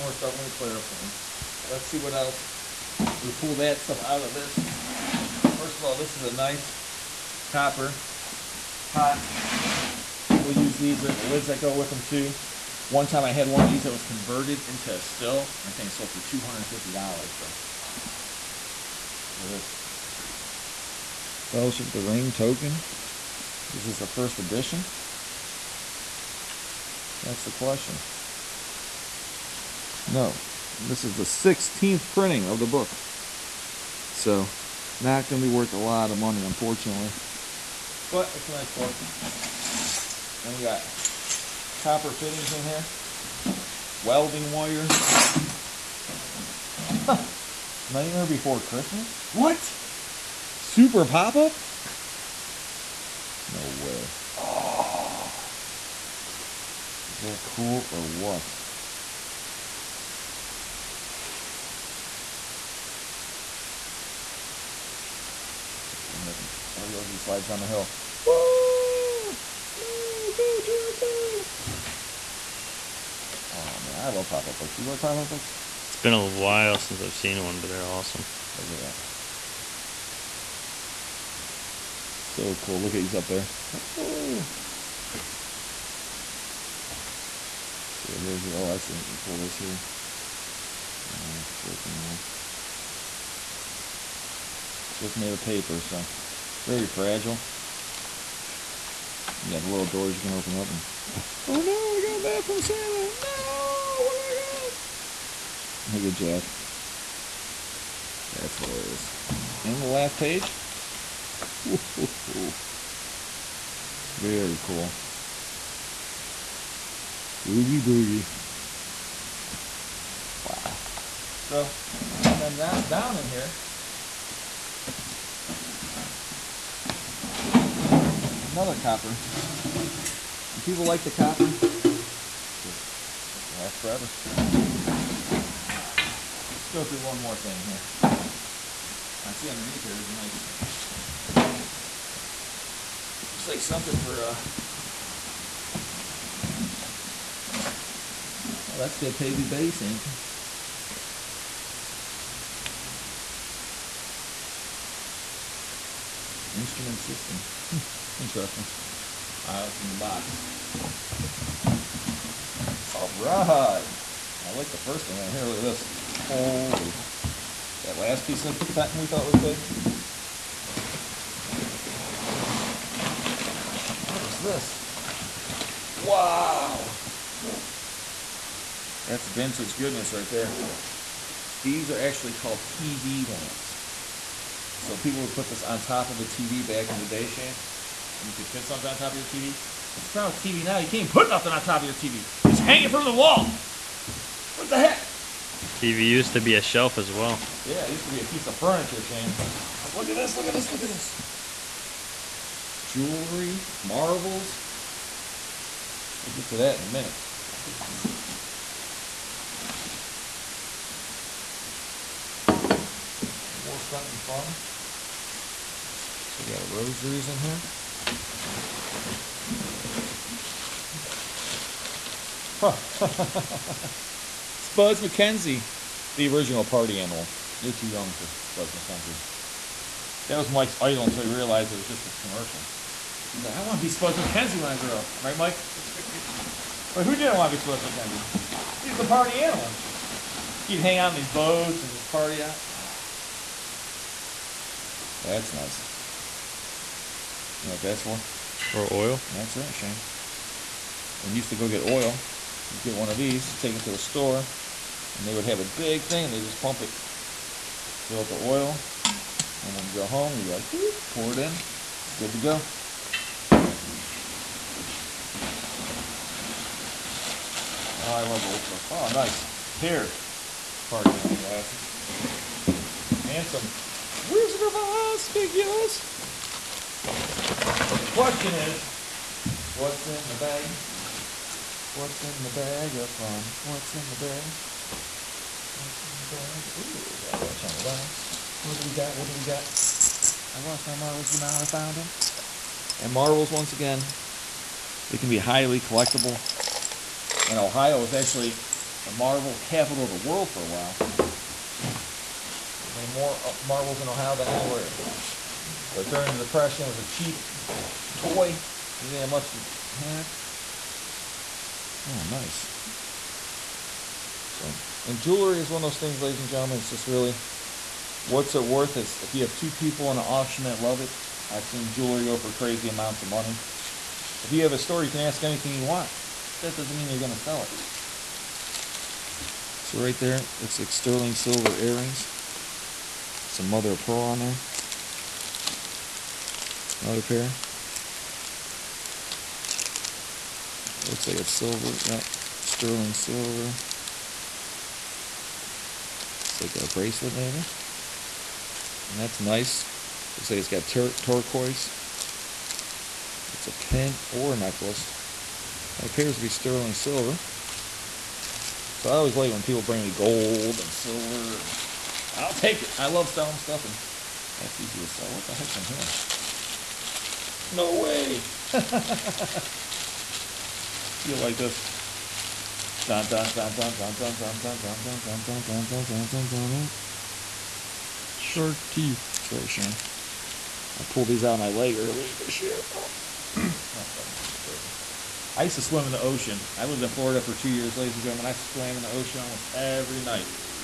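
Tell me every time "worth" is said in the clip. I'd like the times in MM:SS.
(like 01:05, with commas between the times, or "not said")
00:35, 05:18.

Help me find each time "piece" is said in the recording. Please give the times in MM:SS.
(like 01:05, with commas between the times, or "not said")
02:48, 03:18.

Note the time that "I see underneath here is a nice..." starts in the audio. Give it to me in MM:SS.
02:19.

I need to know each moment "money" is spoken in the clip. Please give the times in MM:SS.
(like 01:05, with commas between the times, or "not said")
00:36, 05:23.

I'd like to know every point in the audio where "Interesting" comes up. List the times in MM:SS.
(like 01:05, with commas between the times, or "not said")
02:38.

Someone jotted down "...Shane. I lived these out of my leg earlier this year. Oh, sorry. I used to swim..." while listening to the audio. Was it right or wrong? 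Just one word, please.
wrong.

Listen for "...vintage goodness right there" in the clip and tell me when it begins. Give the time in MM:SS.
02:59.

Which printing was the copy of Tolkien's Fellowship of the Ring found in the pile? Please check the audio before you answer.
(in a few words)
16th printing.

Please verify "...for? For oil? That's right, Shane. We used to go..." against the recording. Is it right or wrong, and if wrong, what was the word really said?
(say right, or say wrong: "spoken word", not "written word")
right.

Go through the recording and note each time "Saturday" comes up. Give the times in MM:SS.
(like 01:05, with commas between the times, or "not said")
not said.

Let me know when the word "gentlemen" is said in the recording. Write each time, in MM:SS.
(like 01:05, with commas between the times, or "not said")
05:16, 06:28.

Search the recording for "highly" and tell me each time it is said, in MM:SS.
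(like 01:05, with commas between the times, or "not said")
04:55.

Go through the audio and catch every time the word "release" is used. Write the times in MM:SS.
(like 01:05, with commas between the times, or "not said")
not said.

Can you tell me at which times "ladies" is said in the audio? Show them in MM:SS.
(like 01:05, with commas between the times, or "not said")
05:16, 06:27.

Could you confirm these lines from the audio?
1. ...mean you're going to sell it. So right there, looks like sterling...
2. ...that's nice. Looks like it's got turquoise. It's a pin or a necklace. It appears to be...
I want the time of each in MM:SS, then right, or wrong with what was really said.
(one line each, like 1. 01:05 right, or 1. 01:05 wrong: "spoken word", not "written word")
1. 05:26 right
2. 05:49 right.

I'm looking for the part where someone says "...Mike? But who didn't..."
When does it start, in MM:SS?
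03:55.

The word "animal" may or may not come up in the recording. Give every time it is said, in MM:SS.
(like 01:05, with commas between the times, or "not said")
03:46, 03:59.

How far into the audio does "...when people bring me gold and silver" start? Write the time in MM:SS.
05:59.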